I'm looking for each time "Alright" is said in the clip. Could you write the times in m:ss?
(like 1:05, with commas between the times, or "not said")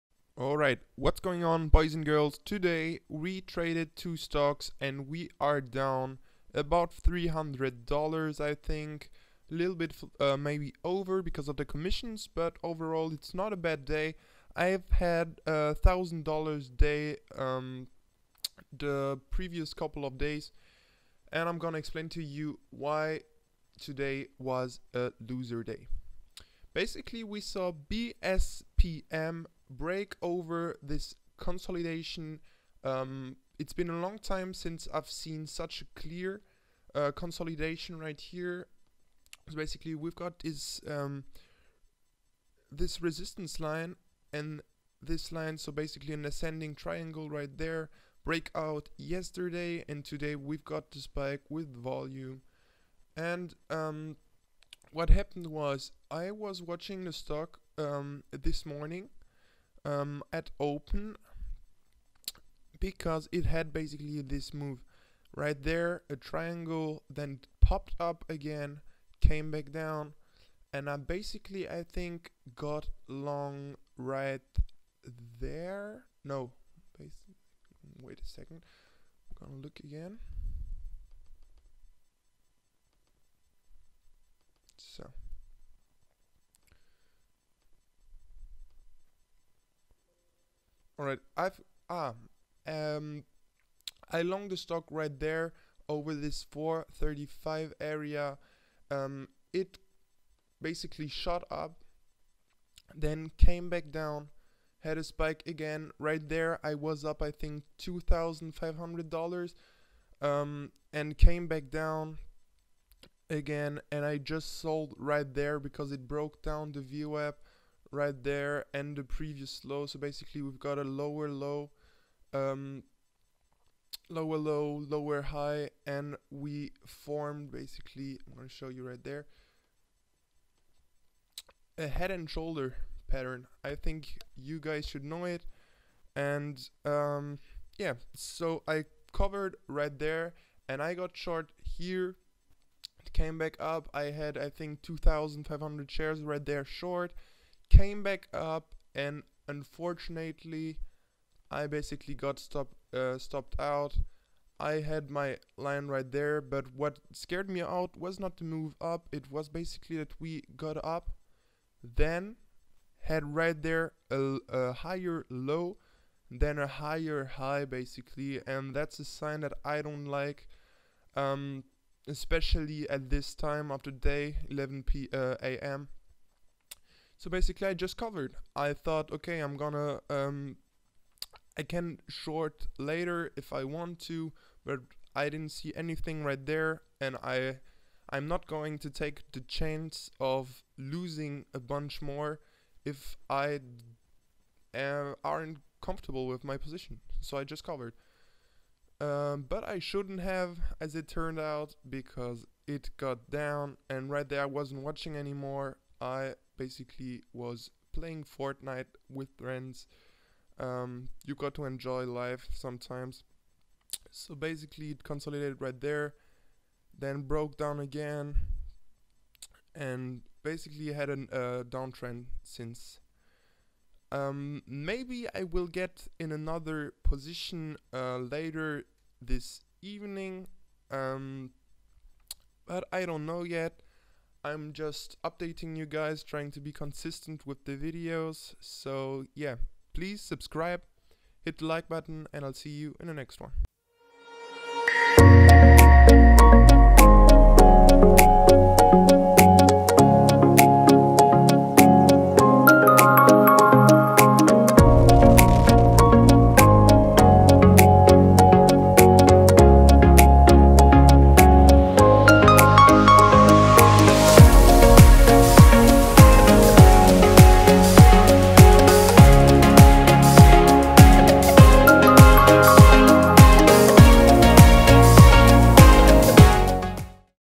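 0:00, 1:31.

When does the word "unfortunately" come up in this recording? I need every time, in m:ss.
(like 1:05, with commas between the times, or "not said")
2:29.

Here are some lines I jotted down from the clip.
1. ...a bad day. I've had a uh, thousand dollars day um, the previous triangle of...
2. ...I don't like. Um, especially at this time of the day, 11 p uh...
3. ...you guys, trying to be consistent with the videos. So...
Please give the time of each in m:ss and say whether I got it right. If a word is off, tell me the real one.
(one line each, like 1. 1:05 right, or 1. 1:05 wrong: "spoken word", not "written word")
1. 0:13 wrong: "couple", not "triangle"
2. 2:49 right
3. 3:55 right.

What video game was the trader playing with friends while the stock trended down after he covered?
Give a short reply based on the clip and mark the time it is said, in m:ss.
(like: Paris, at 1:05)
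Fortnite, at 3:28.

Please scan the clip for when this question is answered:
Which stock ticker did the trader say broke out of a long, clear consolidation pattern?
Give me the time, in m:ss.
0:27.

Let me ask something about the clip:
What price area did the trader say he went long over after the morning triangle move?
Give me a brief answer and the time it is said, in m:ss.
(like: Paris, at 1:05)
435, at 1:36.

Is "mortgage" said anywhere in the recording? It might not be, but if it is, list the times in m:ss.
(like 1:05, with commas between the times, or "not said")
not said.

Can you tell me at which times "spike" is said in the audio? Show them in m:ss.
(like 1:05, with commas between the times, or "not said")
0:50, 1:45.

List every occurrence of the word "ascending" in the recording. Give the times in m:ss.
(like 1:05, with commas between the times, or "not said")
0:46.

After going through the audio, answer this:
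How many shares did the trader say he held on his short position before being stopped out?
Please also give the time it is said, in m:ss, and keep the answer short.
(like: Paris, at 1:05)
2,500, at 2:24.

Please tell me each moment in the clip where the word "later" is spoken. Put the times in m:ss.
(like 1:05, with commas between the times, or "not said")
3:02, 3:48.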